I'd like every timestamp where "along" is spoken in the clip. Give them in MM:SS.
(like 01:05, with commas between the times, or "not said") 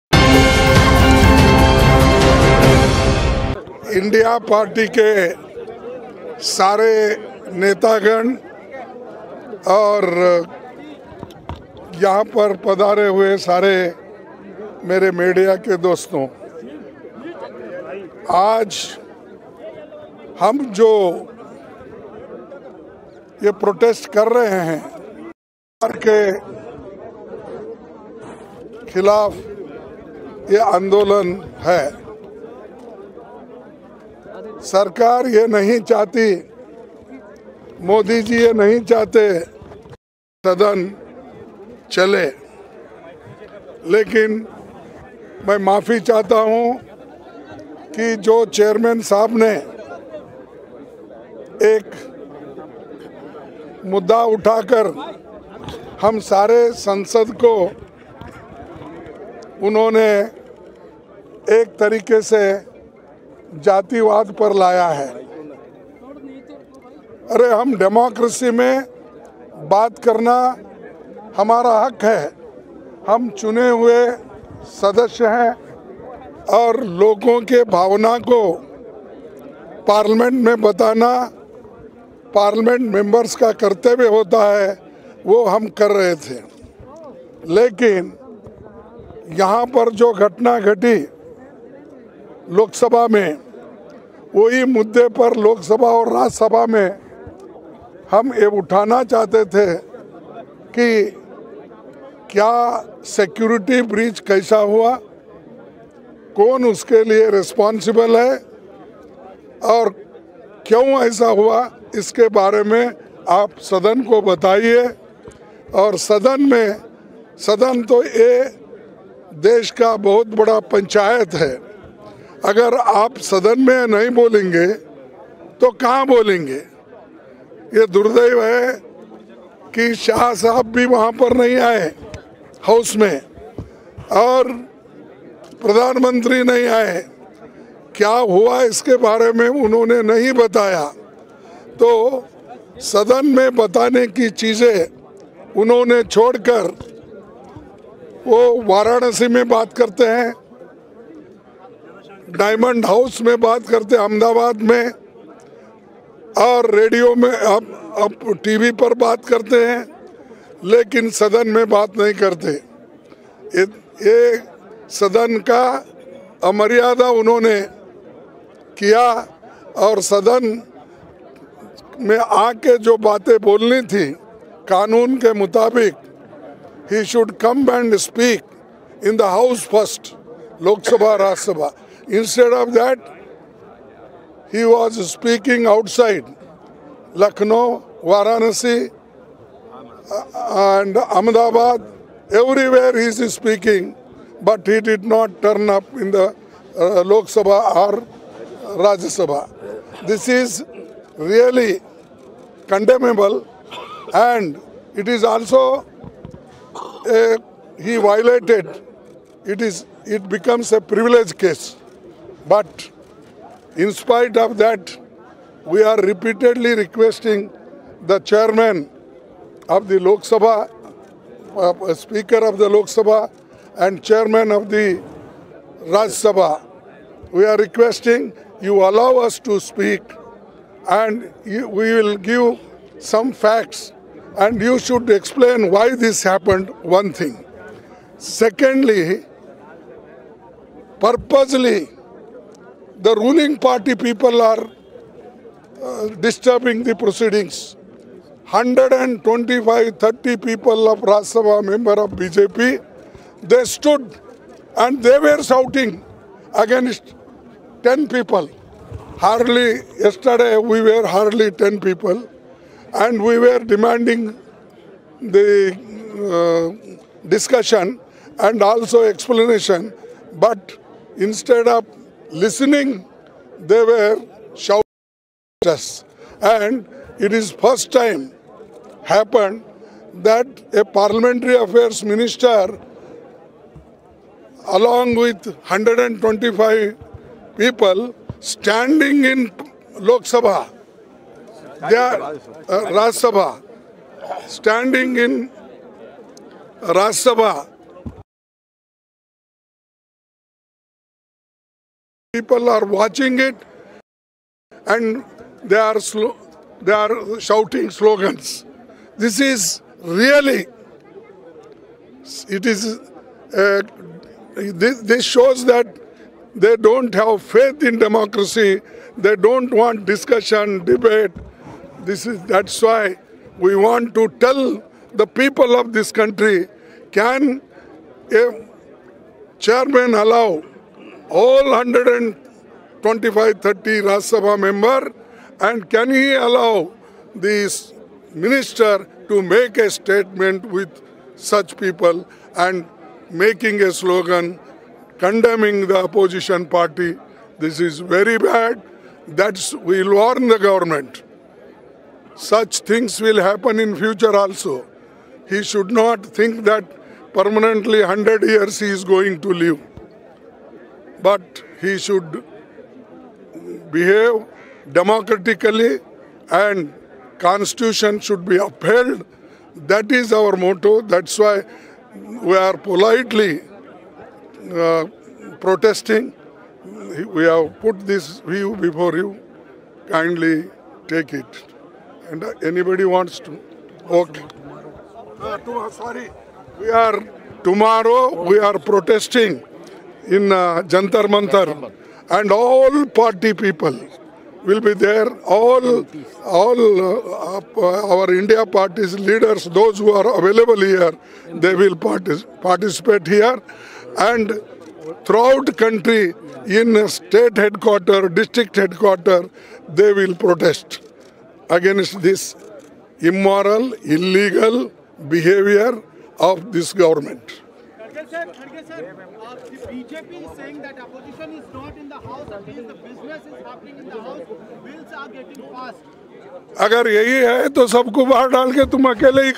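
04:44.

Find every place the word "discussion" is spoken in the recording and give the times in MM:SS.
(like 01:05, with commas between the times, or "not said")
04:27, 05:20.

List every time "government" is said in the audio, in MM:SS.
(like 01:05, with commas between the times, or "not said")
05:50, 06:56.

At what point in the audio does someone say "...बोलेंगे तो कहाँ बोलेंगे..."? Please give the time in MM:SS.
02:04.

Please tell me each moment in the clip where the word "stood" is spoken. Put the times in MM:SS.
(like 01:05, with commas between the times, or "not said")
04:13.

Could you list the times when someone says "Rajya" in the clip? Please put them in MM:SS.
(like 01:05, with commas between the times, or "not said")
03:18, 04:10.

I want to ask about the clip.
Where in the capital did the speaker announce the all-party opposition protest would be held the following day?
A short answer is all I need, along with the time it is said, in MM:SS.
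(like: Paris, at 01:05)
Jantar Mantar, at 06:30.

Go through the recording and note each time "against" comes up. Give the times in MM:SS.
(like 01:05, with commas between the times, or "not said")
04:16, 06:51.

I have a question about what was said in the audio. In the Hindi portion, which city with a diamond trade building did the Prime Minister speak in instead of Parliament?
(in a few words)
Ahmedabad.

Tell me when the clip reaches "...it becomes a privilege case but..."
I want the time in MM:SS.
03:30.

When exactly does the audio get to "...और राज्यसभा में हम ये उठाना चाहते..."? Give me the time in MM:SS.
01:35.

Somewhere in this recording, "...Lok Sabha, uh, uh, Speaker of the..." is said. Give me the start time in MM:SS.
03:39.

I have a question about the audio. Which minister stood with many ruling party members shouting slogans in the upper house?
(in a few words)
Parliamentary affairs minister.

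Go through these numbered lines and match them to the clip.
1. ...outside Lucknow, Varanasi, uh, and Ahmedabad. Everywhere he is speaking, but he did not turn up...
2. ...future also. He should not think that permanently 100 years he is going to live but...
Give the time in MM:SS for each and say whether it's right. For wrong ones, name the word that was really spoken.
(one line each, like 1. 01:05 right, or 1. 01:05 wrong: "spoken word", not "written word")
1. 03:05 right
2. 05:53 right.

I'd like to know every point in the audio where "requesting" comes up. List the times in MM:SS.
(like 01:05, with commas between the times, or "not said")
03:36, 03:47.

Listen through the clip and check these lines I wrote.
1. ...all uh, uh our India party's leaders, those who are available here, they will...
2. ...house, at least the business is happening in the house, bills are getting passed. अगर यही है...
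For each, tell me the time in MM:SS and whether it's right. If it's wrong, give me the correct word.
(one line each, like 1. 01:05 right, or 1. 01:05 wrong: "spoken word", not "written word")
1. 06:36 right
2. 07:02 right.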